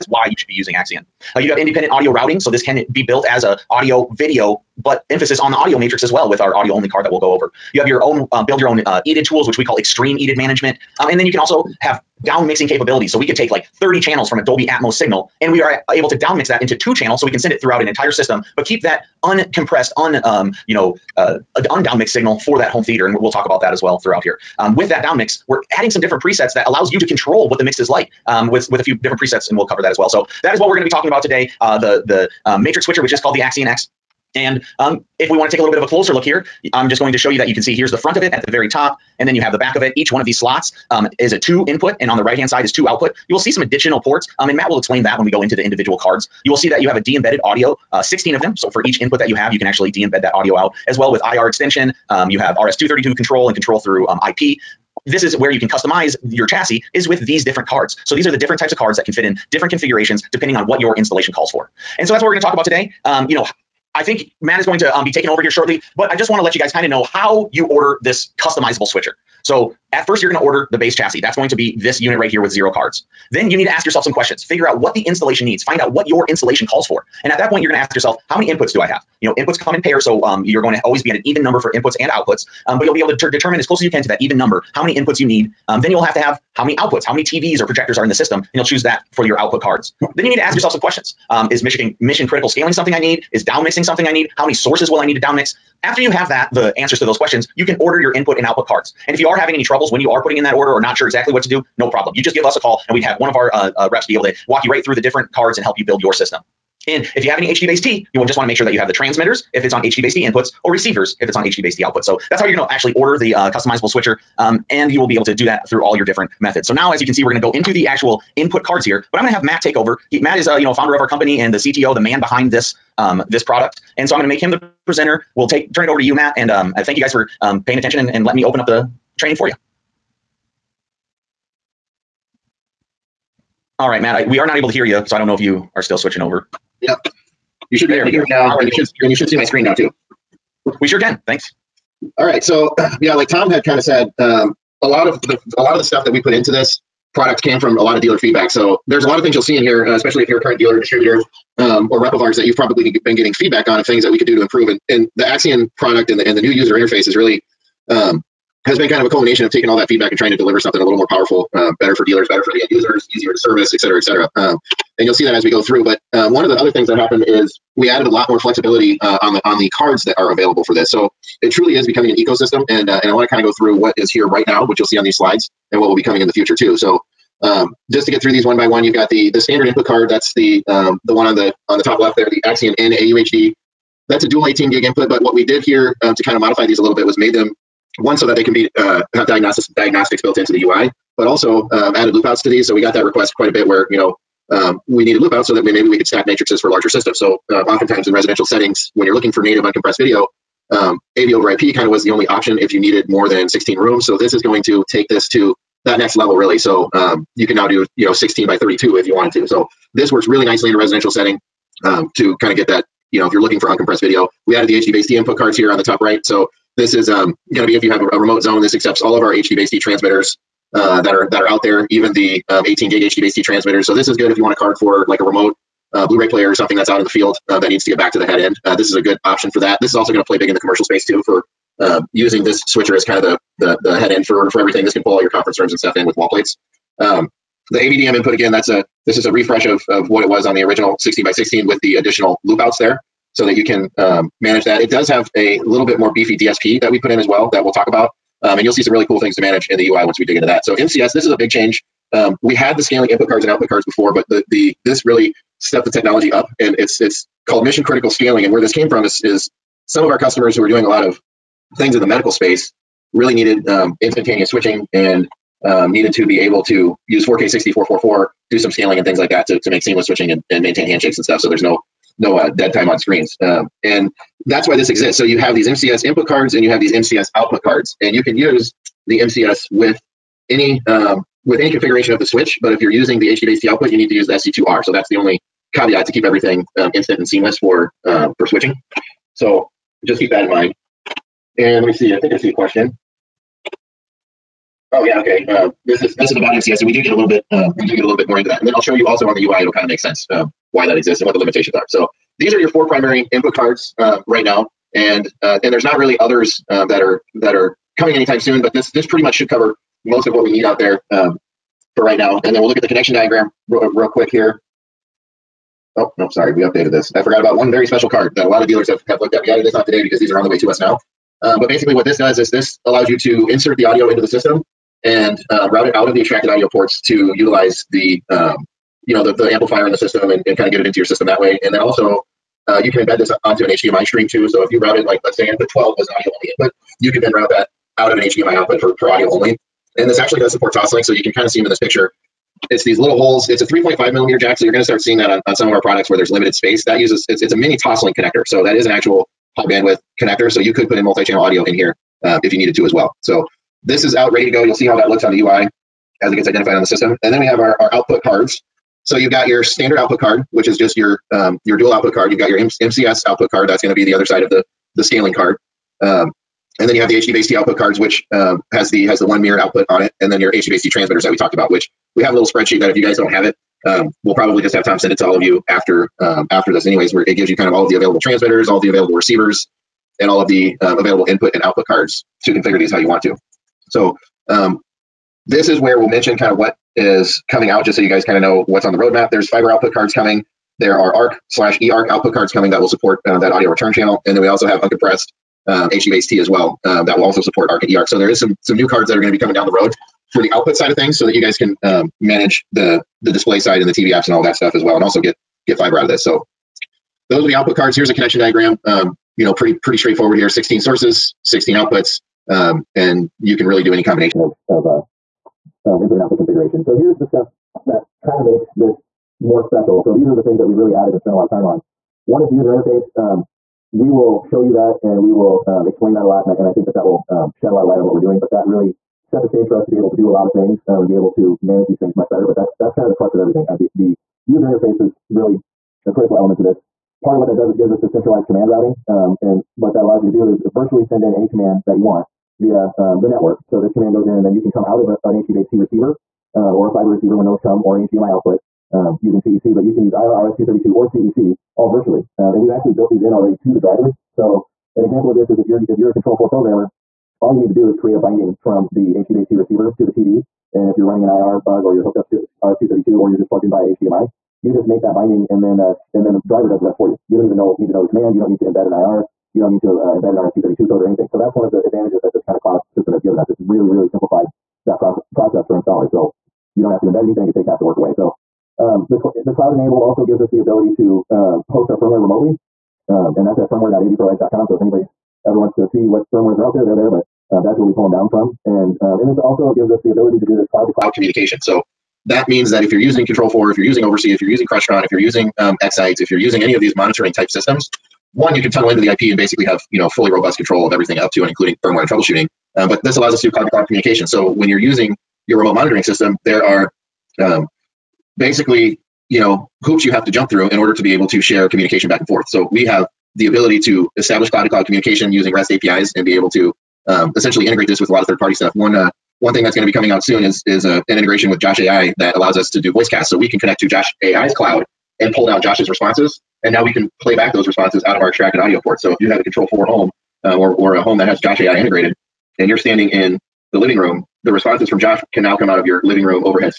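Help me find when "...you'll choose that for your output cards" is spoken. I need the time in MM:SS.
01:28.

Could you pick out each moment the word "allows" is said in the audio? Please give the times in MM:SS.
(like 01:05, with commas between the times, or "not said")
00:26, 05:22, 07:20, 08:23, 08:42.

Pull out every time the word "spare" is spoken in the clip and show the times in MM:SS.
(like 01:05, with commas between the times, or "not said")
not said.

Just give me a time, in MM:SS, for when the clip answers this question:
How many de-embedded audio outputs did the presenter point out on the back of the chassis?
00:48.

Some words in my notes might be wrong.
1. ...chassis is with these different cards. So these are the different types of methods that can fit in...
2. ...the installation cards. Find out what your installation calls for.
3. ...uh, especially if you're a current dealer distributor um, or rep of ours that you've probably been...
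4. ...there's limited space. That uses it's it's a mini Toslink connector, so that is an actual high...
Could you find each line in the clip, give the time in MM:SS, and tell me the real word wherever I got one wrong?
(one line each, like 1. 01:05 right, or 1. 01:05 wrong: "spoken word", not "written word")
1. 00:56 wrong: "cards", not "methods"
2. 01:14 wrong: "needs", not "cards"
3. 02:29 right
4. 05:46 right.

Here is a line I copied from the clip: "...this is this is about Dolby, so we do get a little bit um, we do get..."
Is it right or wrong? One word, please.
wrong.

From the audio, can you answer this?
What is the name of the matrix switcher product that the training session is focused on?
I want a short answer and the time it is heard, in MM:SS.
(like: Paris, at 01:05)
Axion X, at 00:33.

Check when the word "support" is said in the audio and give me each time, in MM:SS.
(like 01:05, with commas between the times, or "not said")
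05:40, 06:32, 06:37.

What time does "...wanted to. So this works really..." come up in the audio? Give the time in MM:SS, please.
03:29.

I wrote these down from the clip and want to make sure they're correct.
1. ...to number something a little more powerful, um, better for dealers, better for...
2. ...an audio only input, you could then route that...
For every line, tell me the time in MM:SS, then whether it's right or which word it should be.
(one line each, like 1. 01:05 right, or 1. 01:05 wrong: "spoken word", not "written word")
1. 02:40 wrong: "deliver", not "number"
2. 05:36 right.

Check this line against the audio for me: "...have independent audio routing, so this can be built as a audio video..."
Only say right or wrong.
right.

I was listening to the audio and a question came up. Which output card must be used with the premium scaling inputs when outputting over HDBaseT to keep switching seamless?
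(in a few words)
SC2R.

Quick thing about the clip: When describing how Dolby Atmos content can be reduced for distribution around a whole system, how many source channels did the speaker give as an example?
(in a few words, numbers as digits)
30.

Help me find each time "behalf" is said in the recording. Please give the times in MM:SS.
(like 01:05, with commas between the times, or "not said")
not said.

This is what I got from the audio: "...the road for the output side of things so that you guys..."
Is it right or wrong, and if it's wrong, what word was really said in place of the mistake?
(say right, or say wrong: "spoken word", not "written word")
right.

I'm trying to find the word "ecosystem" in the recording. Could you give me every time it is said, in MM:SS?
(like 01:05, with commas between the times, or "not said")
02:52.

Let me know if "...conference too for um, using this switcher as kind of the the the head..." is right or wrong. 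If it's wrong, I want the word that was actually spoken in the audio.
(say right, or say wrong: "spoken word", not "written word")
wrong: "space", not "conference".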